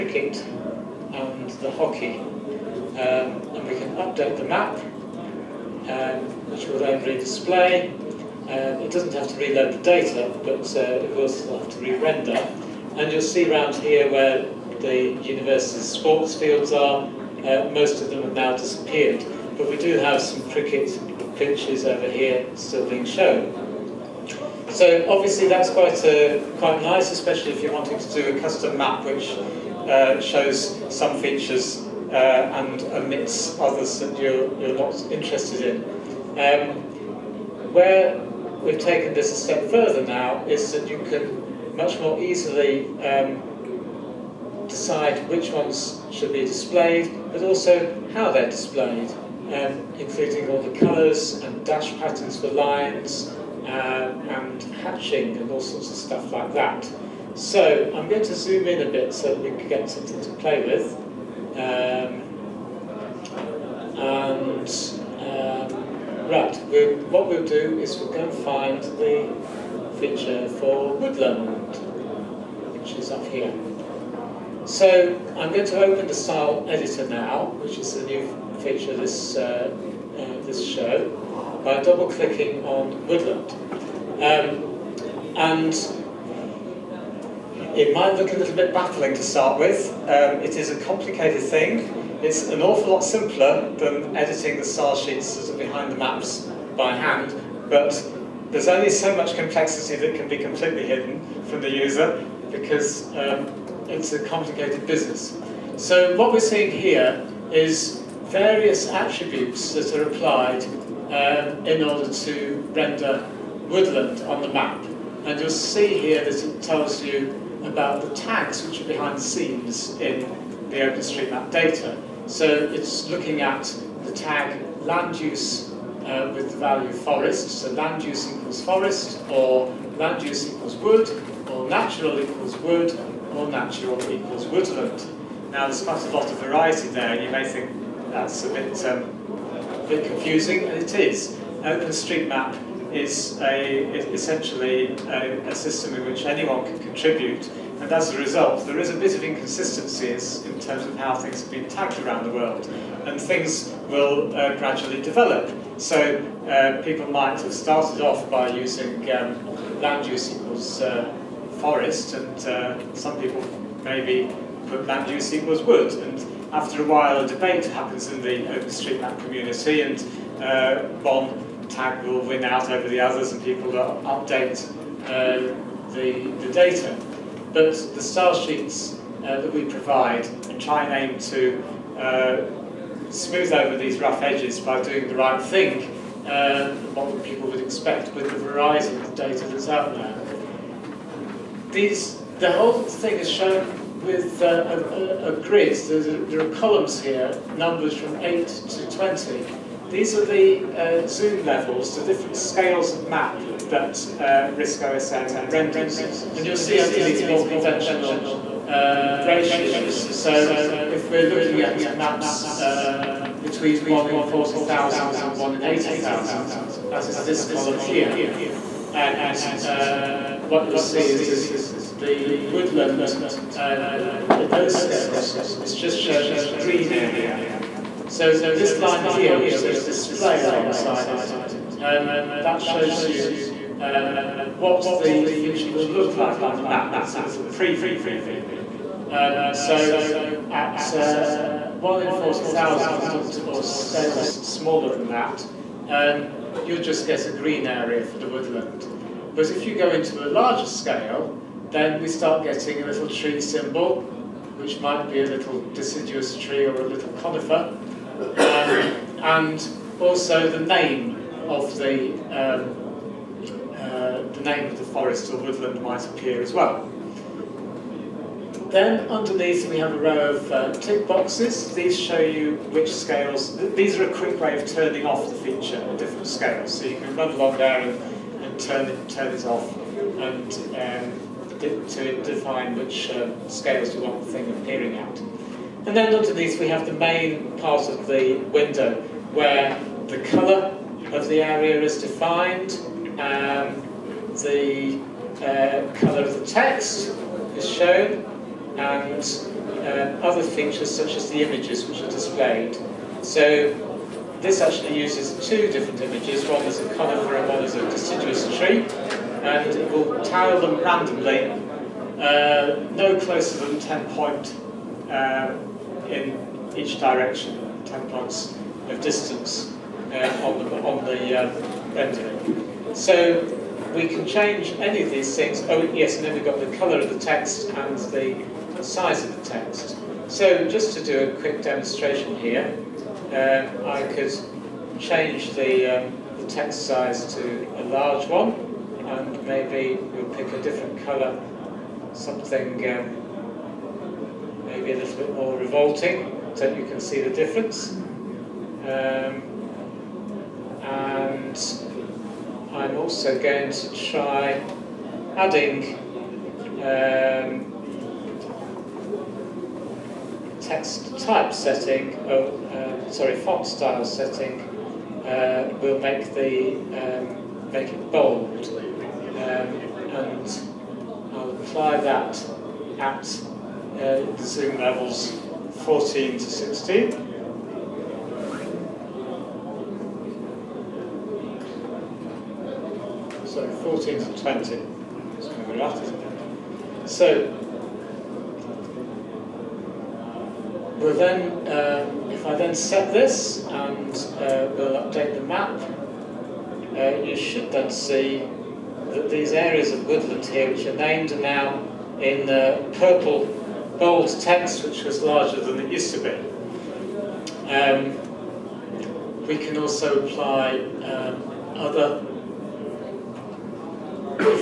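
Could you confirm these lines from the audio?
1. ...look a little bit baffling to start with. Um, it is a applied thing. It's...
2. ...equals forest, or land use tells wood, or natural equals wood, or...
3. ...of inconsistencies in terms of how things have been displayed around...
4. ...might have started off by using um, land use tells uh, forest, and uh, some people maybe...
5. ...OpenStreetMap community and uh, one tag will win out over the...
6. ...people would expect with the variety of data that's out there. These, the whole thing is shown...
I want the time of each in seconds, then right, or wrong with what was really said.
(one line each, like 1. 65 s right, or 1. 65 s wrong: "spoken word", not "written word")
1. 88 s wrong: "complicated", not "applied"
2. 128 s wrong: "equals", not "tells"
3. 149 s wrong: "tagged", not "displayed"
4. 157 s wrong: "equals", not "tells"
5. 168 s right
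6. 187 s right.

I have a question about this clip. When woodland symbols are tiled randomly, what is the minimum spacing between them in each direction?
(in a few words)
10 points.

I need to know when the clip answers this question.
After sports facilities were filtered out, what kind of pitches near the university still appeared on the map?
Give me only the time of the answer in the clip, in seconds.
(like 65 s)
20 s.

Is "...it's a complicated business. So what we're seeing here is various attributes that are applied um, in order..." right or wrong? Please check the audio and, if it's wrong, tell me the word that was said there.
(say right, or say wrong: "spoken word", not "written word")
right.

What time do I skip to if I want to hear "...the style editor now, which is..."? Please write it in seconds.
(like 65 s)
76 s.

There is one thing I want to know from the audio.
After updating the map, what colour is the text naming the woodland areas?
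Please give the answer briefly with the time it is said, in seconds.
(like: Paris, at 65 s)
Purple, at 402 s.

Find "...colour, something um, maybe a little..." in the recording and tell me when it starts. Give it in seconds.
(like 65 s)
341 s.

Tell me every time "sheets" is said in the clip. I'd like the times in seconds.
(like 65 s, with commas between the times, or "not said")
94 s, 178 s.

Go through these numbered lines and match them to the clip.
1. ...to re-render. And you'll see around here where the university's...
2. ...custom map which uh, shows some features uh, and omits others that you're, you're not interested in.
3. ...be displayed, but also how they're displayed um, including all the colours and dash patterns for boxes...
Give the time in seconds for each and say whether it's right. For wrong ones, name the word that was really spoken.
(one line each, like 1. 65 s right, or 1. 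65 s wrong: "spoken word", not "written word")
1. 11 s right
2. 28 s right
3. 46 s wrong: "lines", not "boxes".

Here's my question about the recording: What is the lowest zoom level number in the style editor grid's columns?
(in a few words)
8.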